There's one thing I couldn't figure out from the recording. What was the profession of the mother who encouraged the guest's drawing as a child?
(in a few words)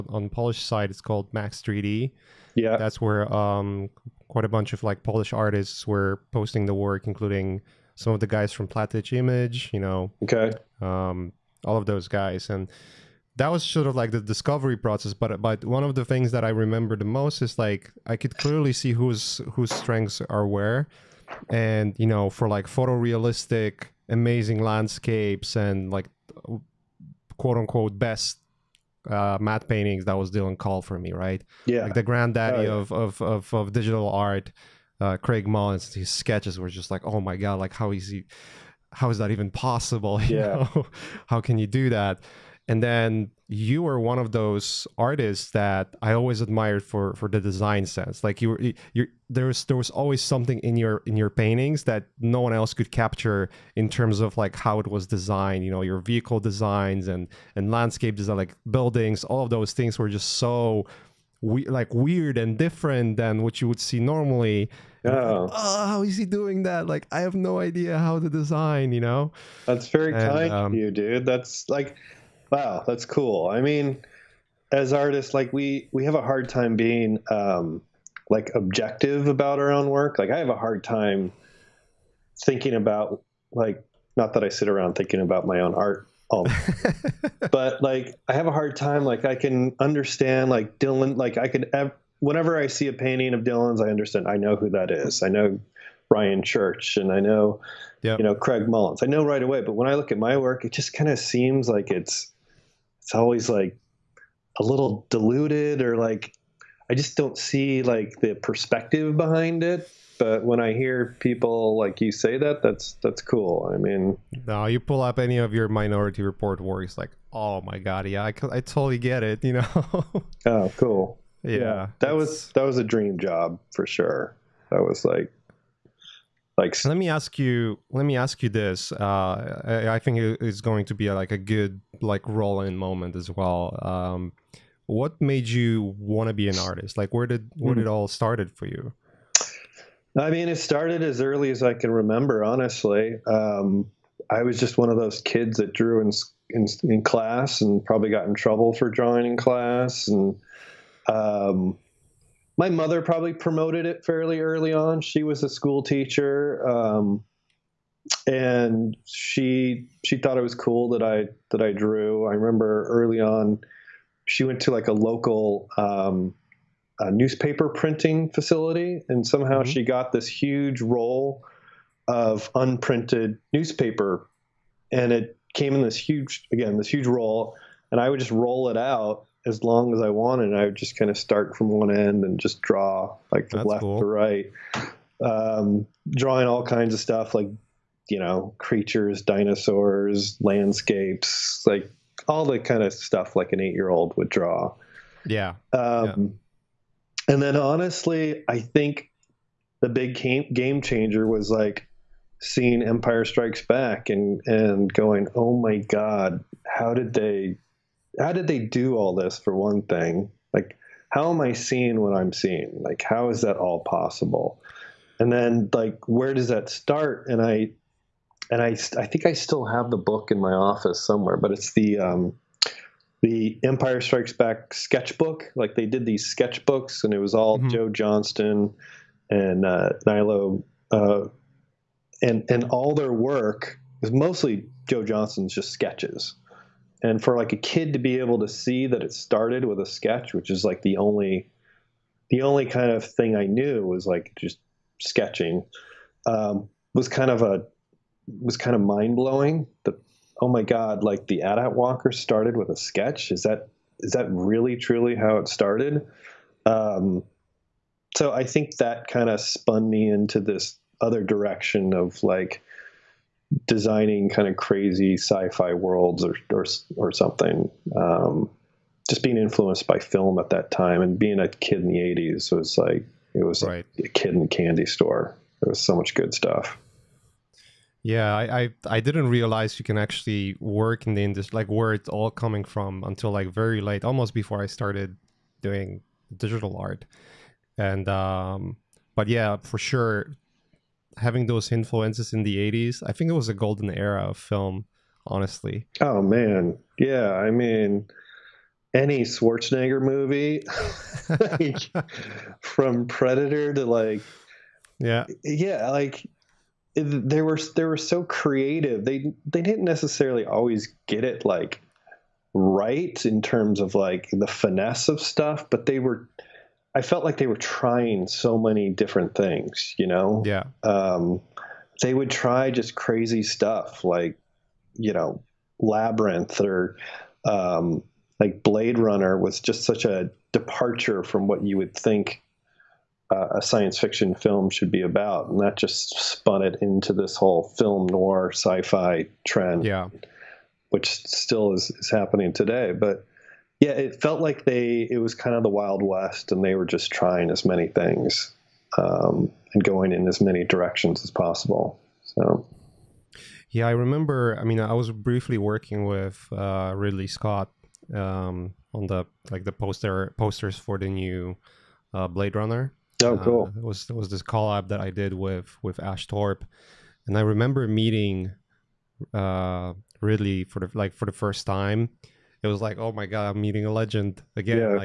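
School teacher.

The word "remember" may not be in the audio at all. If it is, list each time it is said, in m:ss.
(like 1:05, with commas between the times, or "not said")
0:16, 2:22, 2:42, 5:53, 6:07.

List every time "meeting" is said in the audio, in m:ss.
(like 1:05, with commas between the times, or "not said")
6:07, 6:13.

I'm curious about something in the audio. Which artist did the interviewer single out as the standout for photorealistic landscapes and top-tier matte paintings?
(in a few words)
Dylan Cole.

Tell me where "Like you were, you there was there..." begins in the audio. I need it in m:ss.
0:48.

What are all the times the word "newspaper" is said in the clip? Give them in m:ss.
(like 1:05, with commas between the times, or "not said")
2:47, 2:53.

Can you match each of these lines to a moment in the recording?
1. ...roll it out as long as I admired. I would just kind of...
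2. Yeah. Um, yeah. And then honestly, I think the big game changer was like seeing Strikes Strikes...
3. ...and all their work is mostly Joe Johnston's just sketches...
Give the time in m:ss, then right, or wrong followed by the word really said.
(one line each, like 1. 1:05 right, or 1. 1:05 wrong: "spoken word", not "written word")
1. 2:58 wrong: "wanted", not "admired"
2. 3:15 wrong: "Empire", not "Strikes"
3. 3:52 right.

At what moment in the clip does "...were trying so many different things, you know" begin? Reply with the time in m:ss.
5:17.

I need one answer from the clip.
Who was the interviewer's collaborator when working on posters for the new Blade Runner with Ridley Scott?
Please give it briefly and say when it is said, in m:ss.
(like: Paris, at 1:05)
Ash Torp, at 6:05.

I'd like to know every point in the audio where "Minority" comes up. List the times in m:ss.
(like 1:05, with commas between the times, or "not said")
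1:55.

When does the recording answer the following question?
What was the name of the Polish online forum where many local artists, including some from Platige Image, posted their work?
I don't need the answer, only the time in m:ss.
0:01.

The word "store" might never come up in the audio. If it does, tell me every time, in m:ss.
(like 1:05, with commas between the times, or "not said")
4:34.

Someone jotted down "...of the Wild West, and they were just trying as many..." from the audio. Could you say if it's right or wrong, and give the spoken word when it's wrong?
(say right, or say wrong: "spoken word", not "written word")
right.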